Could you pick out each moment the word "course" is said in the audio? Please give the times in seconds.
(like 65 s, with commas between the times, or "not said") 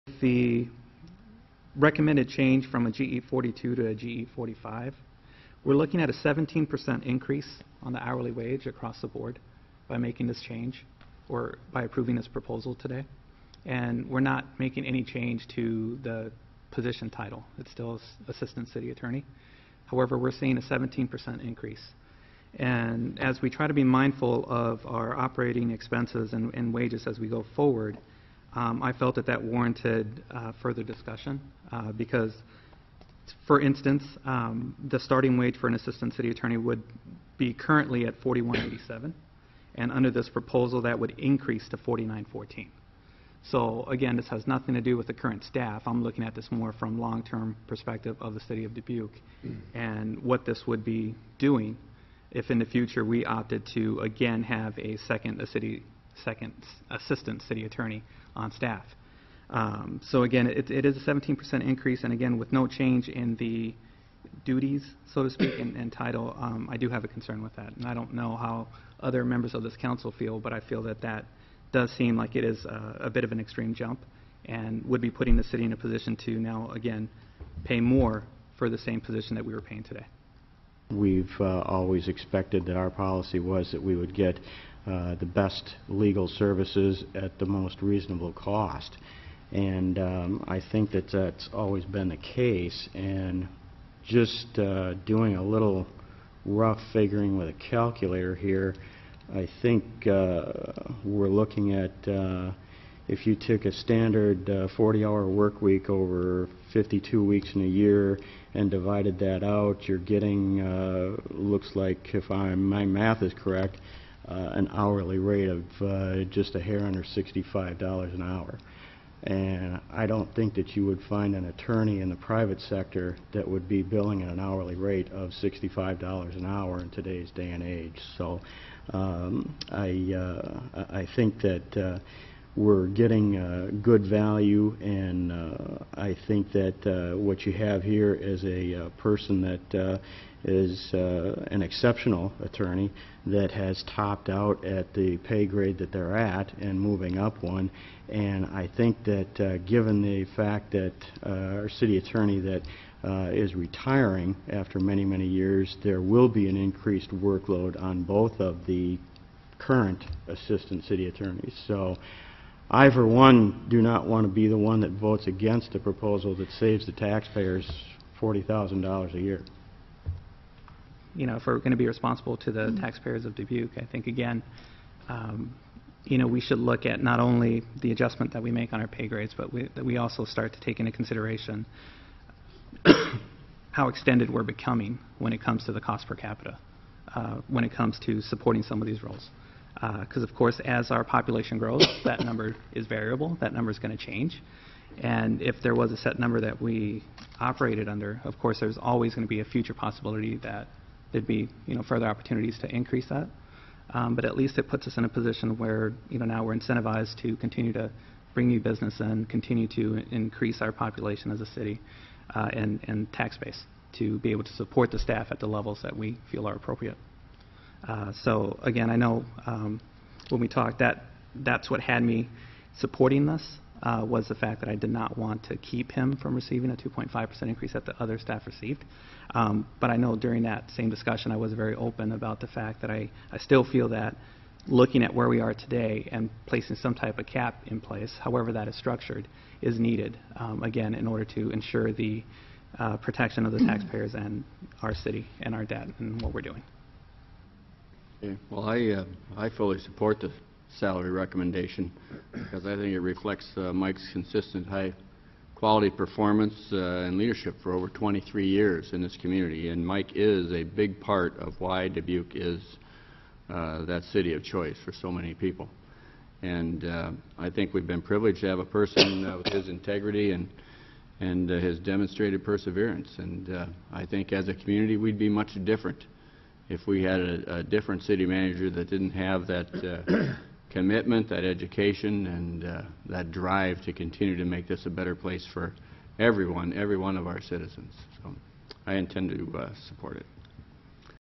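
190 s, 198 s.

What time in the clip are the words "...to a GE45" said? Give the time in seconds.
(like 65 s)
3 s.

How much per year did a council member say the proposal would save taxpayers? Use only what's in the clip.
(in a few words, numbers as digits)
$40,000.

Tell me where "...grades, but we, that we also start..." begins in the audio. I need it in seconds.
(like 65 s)
179 s.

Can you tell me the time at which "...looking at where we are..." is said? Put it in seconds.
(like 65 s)
234 s.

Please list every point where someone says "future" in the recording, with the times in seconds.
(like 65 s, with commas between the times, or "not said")
52 s, 199 s.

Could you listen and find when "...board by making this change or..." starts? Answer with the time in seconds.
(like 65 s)
9 s.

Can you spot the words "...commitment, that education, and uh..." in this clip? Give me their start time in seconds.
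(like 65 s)
280 s.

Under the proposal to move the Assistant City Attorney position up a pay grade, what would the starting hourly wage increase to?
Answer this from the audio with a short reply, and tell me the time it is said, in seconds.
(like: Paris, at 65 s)
$49.14, at 41 s.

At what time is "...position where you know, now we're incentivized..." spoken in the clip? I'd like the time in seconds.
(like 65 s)
205 s.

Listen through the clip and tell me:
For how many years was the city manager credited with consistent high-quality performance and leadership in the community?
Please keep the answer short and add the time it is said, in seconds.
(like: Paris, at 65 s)
23 years, at 257 s.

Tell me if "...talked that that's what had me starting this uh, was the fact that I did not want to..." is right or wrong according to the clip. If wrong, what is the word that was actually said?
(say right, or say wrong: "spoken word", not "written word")
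wrong: "supporting", not "starting".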